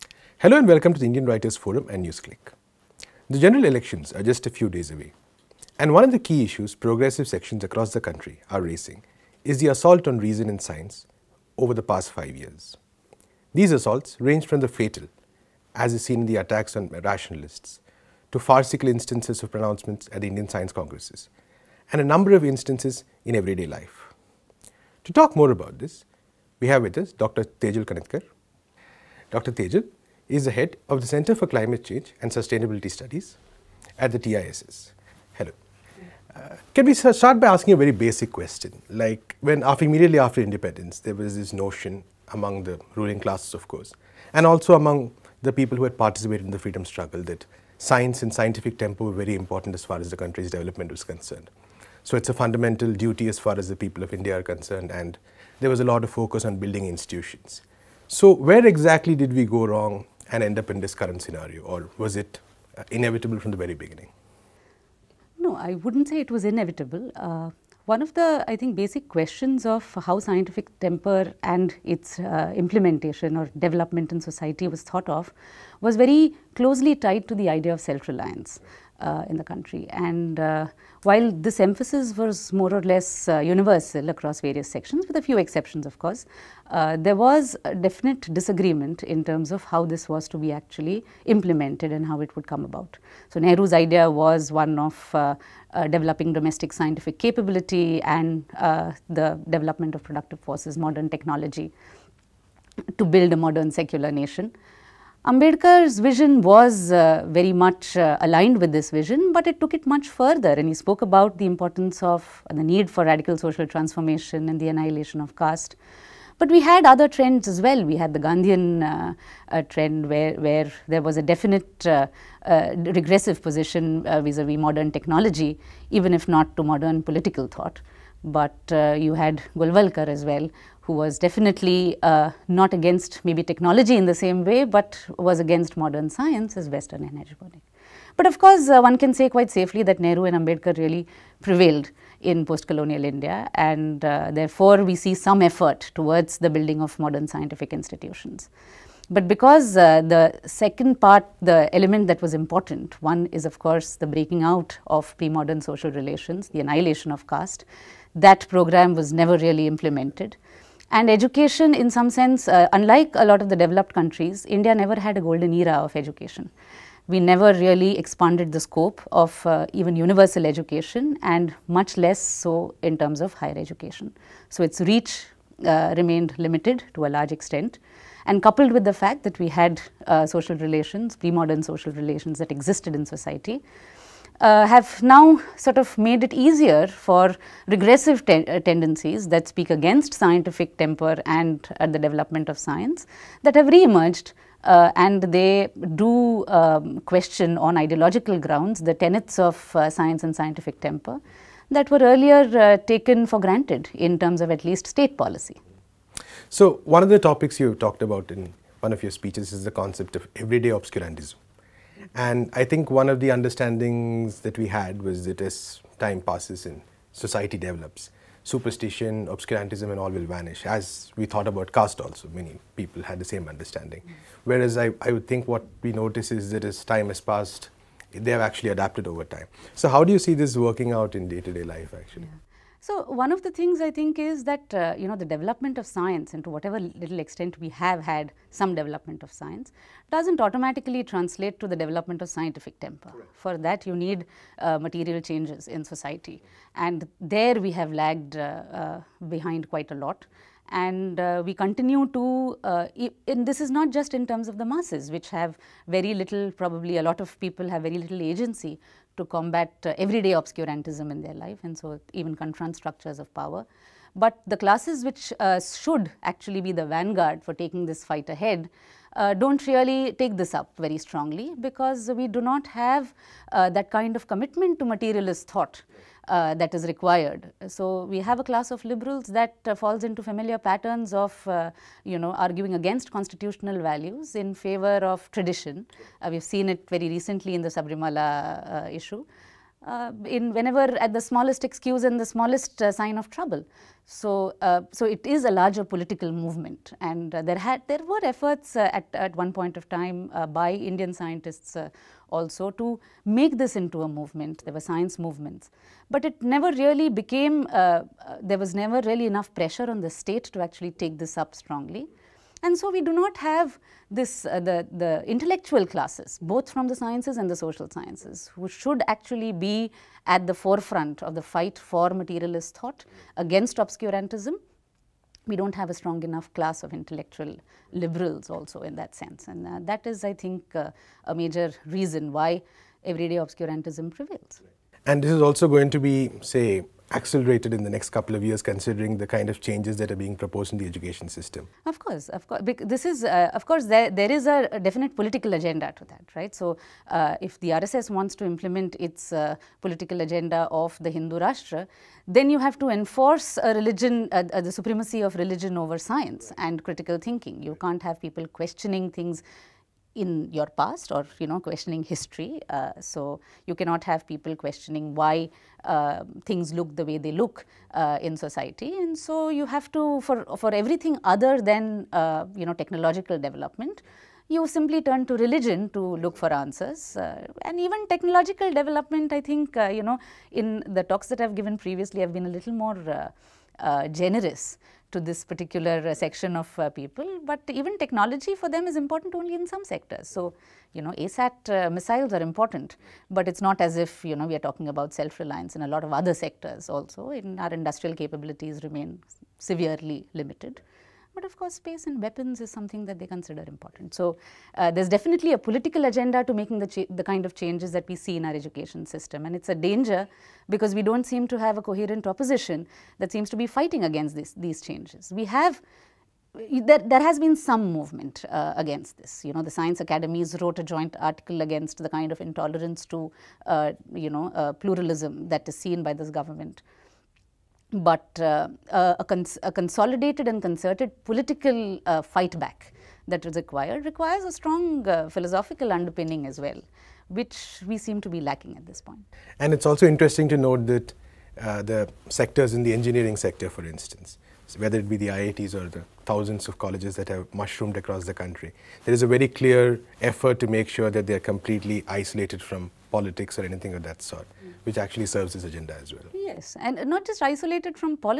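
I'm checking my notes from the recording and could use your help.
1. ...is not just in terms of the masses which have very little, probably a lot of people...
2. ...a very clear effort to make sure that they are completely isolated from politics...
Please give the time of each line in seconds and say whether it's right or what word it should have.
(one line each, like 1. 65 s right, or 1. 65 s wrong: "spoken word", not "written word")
1. 253 s right
2. 449 s right.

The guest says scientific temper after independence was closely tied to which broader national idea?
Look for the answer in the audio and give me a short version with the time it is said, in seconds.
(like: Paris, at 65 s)
Self reliance, at 77 s.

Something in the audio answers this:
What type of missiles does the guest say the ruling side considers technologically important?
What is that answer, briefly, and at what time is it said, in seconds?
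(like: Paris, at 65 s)
ASAT, at 391 s.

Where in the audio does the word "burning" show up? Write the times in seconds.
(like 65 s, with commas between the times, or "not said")
137 s.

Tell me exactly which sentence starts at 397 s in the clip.
In our industrial capabilities remain severely limited but of course space and weapons is something that they consider important.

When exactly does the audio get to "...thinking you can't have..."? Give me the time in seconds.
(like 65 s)
357 s.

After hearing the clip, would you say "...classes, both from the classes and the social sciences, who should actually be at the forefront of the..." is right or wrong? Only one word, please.
wrong.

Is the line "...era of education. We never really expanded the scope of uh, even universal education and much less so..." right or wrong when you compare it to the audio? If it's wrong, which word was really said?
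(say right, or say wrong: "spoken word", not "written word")
right.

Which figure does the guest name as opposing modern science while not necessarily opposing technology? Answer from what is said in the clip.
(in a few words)
Golwalkar.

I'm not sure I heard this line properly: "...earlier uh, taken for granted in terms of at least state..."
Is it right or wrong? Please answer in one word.
right.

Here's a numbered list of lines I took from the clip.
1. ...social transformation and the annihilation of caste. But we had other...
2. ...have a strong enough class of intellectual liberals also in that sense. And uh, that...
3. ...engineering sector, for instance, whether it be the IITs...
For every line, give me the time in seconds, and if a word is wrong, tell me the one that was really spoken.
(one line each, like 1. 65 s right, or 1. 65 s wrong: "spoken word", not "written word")
1. 113 s right
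2. 325 s right
3. 442 s right.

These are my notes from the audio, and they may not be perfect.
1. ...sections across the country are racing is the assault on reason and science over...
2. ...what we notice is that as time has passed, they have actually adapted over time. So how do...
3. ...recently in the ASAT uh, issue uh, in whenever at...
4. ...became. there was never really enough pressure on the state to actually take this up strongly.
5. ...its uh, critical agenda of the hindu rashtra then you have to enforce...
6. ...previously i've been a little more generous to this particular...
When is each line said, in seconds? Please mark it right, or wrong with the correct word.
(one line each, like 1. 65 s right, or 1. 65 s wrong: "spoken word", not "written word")
1. 7 s right
2. 225 s right
3. 287 s wrong: "Sabarimala", not "ASAT"
4. 307 s right
5. 348 s wrong: "political", not "critical"
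6. 381 s right.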